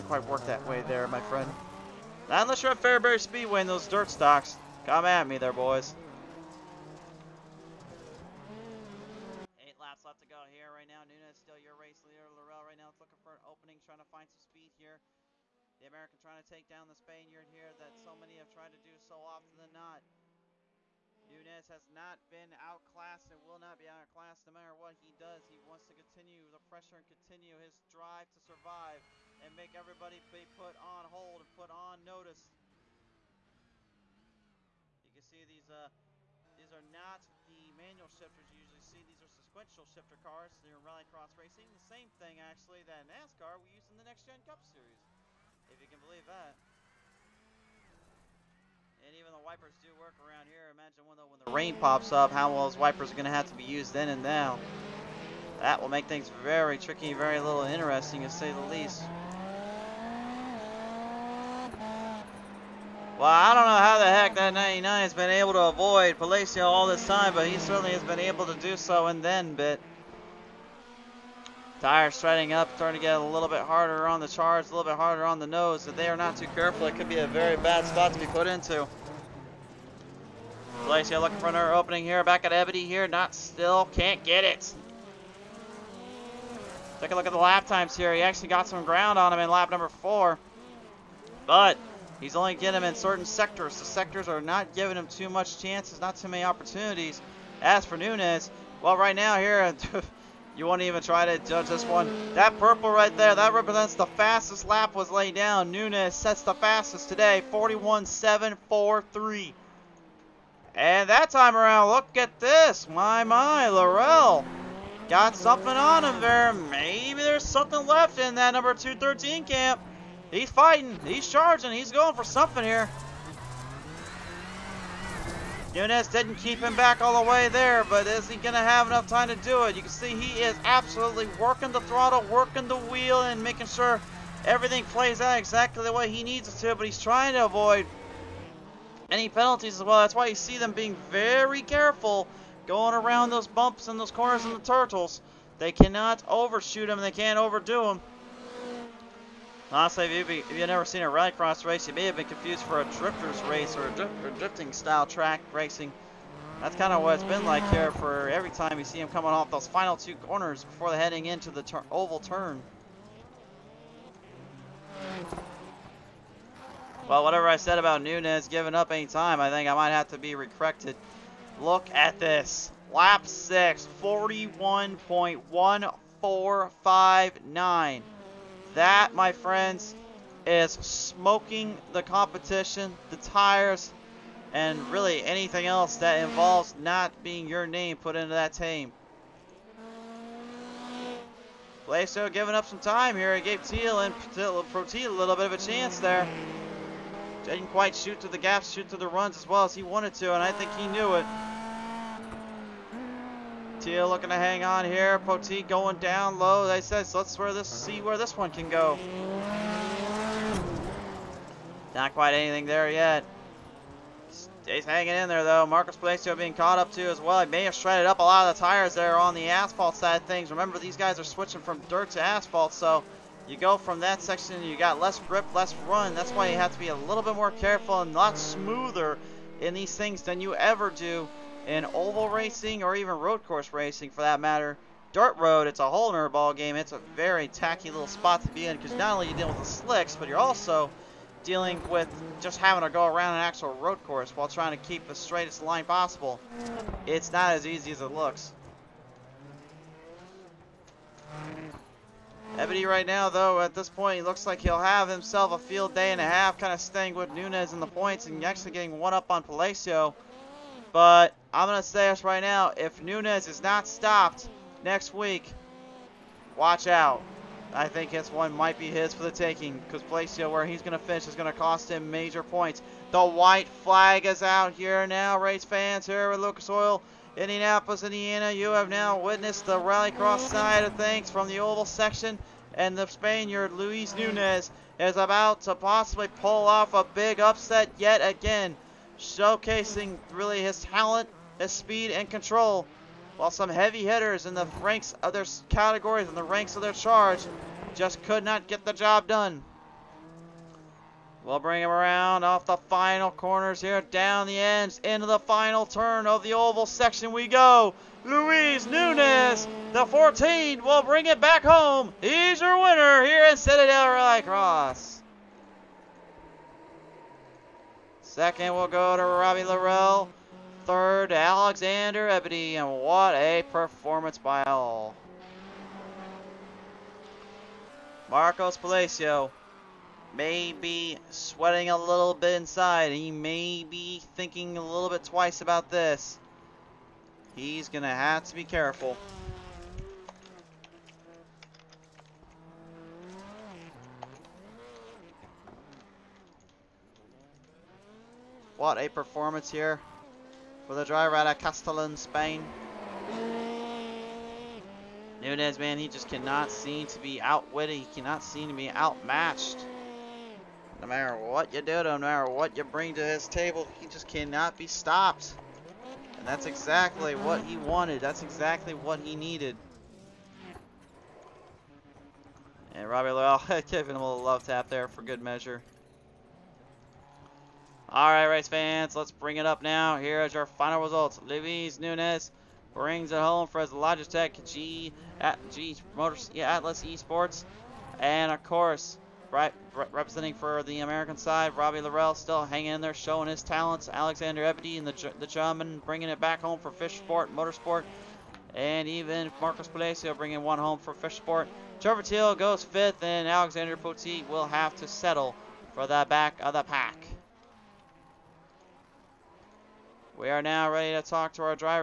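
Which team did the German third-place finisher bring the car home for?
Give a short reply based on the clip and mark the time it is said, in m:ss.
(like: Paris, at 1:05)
Fish Sport Motorsport, at 6:36.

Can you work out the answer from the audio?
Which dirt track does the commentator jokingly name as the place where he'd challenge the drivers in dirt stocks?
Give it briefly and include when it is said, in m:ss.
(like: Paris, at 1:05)
Fairbury Speedway, at 0:02.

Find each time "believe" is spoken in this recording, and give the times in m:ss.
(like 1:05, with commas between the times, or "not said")
0:45.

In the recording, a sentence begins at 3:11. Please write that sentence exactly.
Palacio giving up some time here.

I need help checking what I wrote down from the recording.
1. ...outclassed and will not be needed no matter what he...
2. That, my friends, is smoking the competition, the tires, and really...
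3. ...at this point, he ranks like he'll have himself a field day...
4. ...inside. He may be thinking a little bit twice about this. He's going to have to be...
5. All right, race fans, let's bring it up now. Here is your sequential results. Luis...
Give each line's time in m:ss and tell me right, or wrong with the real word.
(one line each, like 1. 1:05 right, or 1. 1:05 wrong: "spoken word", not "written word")
1. 0:22 wrong: "outclassed", not "needed"
2. 2:58 right
3. 4:13 wrong: "looks", not "ranks"
4. 5:32 right
5. 6:18 wrong: "final", not "sequential".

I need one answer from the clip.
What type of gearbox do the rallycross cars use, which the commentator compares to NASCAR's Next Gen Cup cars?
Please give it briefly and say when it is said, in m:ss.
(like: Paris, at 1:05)
Sequential shifter, at 0:39.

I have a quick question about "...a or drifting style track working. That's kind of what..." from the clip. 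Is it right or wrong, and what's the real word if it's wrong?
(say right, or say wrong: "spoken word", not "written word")
wrong: "racing", not "working".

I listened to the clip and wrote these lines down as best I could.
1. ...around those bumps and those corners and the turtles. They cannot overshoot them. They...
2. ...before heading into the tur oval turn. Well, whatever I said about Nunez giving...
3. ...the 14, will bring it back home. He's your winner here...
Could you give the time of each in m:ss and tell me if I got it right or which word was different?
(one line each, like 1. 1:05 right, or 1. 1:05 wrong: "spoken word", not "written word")
1. 2:22 right
2. 2:40 right
3. 5:09 right.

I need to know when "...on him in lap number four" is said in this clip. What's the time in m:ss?
1:29.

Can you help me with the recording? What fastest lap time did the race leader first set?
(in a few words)
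41.743.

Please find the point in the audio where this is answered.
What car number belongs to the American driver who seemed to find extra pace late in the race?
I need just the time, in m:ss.
1:58.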